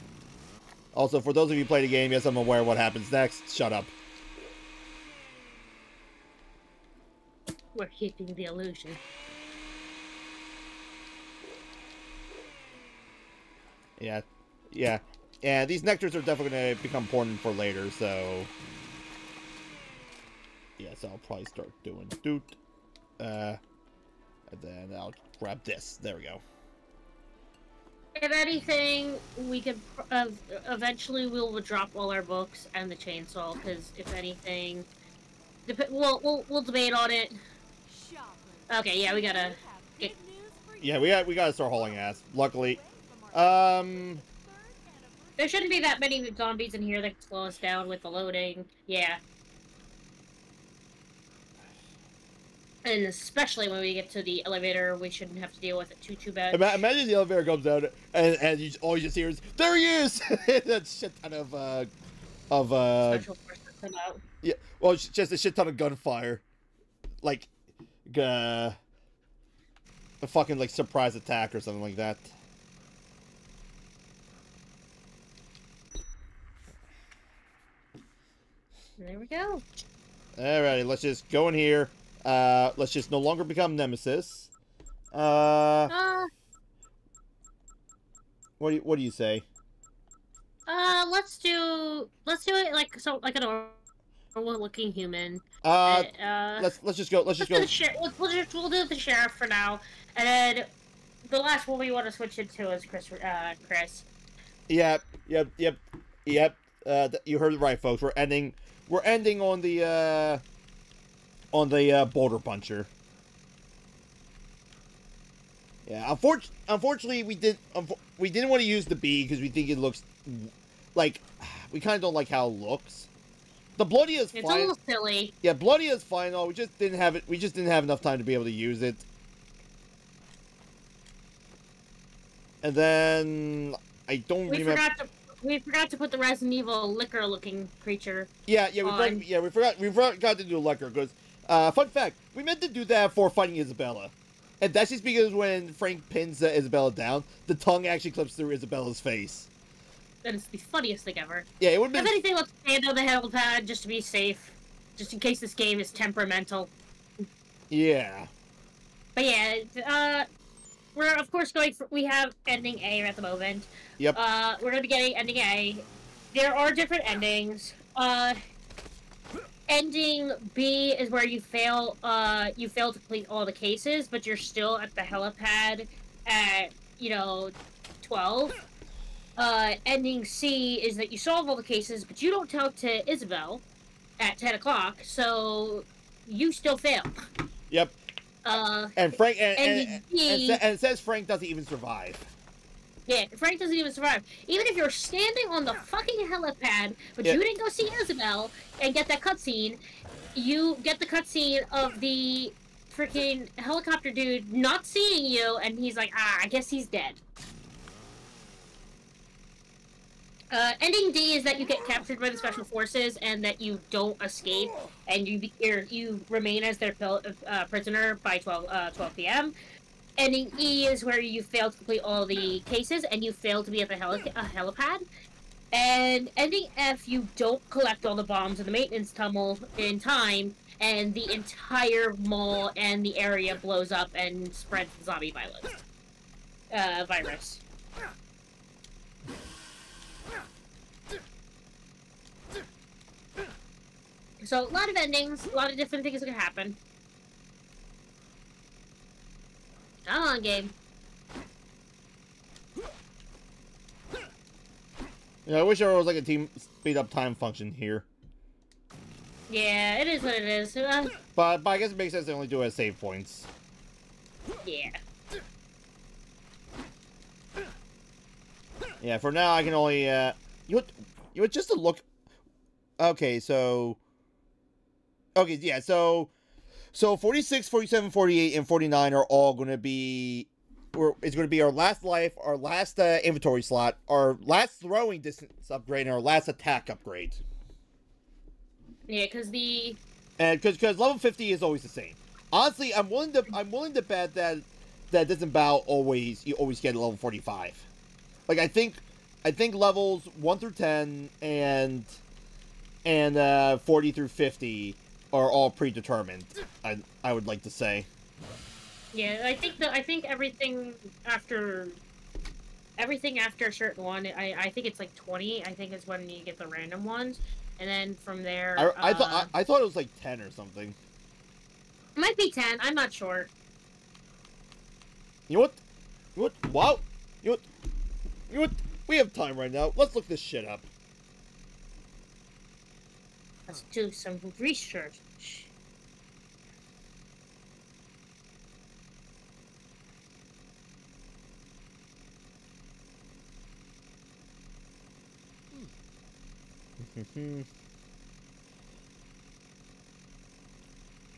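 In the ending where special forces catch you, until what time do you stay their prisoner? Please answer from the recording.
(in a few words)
12 p.m.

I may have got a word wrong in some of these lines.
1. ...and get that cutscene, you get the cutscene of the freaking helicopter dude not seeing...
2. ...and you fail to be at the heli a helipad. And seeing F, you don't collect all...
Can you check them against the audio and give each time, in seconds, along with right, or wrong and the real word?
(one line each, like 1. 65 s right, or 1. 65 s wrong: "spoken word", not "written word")
1. 198 s right
2. 223 s wrong: "ending", not "seeing".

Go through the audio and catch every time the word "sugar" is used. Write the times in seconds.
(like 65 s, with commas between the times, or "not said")
not said.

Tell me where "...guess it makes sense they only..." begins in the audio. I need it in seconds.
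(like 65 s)
261 s.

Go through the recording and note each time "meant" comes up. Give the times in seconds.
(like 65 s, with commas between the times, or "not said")
142 s.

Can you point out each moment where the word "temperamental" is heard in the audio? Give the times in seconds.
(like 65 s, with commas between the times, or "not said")
155 s.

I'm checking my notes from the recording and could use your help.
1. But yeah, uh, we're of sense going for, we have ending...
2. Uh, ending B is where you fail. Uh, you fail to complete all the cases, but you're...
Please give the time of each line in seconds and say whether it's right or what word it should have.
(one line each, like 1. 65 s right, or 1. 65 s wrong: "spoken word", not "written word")
1. 159 s wrong: "course", not "sense"
2. 167 s right.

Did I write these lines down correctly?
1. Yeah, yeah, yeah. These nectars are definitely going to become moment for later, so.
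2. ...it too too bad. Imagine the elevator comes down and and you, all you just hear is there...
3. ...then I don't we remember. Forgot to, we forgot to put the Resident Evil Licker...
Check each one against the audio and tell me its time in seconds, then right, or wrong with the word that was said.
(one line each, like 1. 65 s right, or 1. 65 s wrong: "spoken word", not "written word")
1. 13 s wrong: "important", not "moment"
2. 55 s right
3. 132 s right.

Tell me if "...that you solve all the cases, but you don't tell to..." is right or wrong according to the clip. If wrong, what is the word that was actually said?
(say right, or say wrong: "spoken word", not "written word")
right.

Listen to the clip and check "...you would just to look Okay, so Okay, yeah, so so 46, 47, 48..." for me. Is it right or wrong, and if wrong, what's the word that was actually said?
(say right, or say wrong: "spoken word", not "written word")
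right.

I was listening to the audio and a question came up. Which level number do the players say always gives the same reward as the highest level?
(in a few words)
50.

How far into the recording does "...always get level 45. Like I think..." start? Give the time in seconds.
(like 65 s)
296 s.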